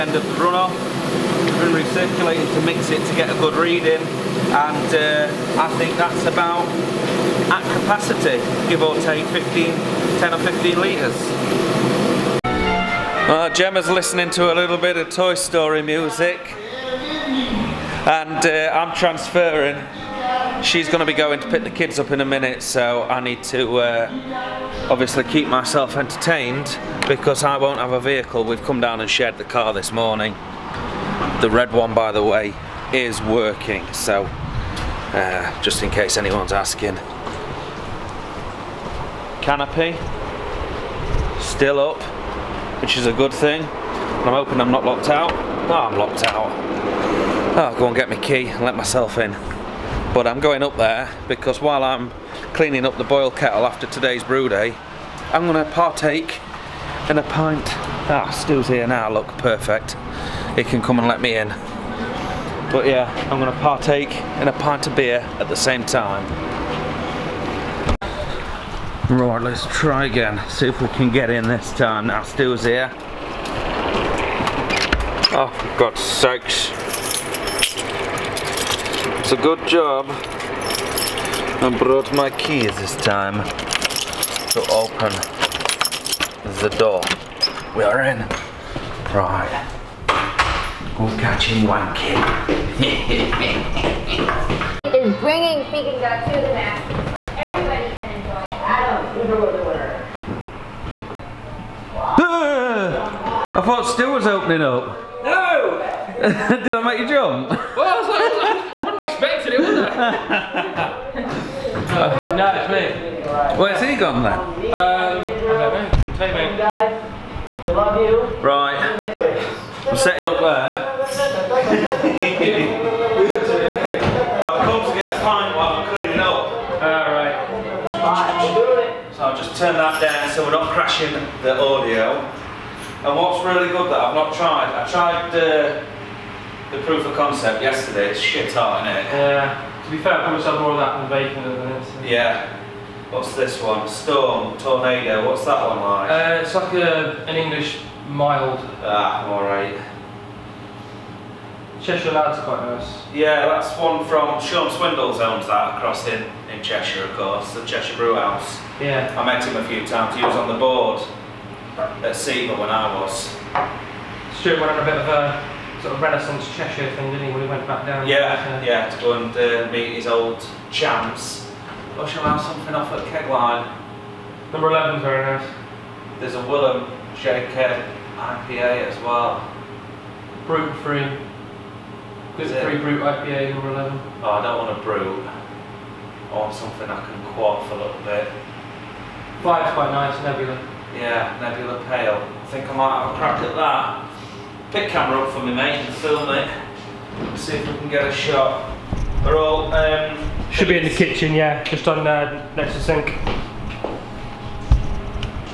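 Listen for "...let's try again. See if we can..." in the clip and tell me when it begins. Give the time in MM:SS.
01:09.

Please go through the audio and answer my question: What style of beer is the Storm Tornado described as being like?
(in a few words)
English mild.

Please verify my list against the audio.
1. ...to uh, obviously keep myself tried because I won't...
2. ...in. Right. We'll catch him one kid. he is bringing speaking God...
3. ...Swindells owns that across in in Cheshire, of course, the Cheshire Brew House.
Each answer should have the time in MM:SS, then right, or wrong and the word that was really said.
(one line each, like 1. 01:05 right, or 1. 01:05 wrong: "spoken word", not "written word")
1. 00:23 wrong: "entertained", not "tried"
2. 01:28 right
3. 02:34 right.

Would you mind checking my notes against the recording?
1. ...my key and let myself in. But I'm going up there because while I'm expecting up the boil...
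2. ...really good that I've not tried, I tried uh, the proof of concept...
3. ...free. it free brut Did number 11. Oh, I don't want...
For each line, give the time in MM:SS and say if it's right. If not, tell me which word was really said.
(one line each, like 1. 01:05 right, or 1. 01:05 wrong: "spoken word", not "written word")
1. 00:48 wrong: "cleaning", not "expecting"
2. 02:13 right
3. 03:00 wrong: "IPA", not "Did".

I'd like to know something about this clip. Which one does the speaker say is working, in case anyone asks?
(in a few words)
The red one.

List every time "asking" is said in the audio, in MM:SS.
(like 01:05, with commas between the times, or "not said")
00:36.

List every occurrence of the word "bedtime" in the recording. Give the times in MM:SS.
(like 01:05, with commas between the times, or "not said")
not said.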